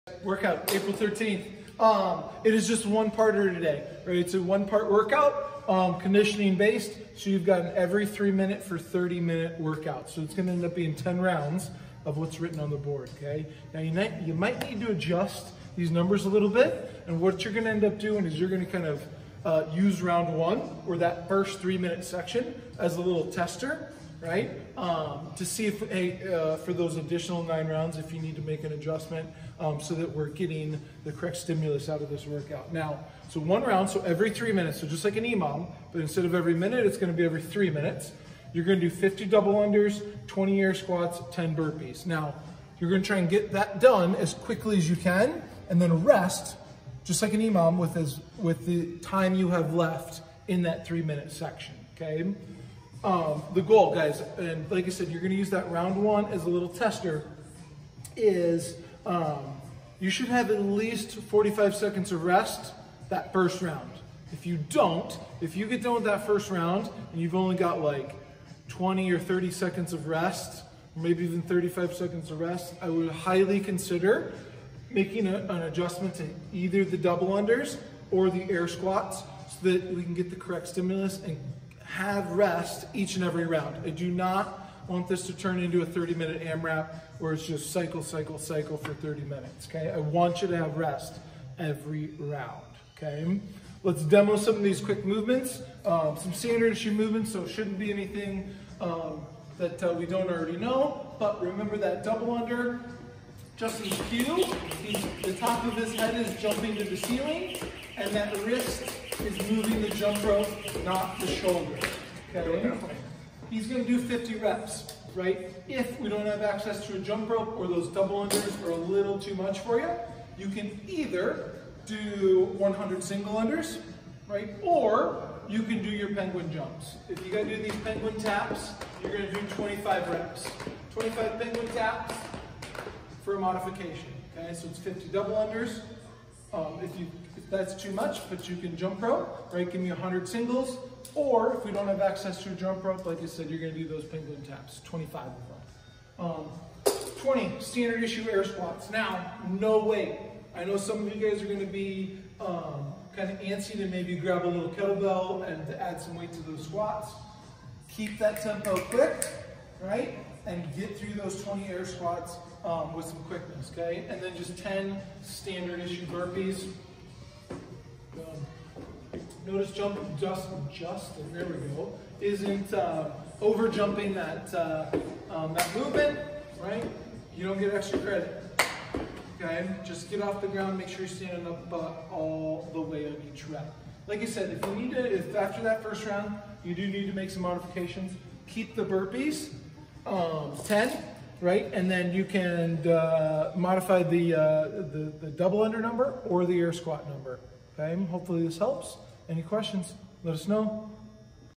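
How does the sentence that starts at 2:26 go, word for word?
Um, 20, standard issue air squats.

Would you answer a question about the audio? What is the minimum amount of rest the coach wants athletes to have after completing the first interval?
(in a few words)
45 seconds.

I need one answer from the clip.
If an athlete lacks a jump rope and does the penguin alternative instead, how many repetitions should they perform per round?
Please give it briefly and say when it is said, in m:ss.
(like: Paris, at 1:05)
25, at 2:09.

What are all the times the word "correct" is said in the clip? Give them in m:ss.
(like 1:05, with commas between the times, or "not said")
0:31, 1:20.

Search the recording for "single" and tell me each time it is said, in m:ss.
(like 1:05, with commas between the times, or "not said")
2:03, 2:20.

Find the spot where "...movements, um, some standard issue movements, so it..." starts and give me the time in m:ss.
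1:35.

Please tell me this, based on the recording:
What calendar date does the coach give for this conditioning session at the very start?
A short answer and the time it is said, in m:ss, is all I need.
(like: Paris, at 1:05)
April 13th, at 0:00.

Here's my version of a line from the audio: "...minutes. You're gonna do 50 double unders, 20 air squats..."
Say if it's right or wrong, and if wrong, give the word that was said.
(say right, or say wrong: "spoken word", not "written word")
right.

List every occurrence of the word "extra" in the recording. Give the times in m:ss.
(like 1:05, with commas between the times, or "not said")
2:57.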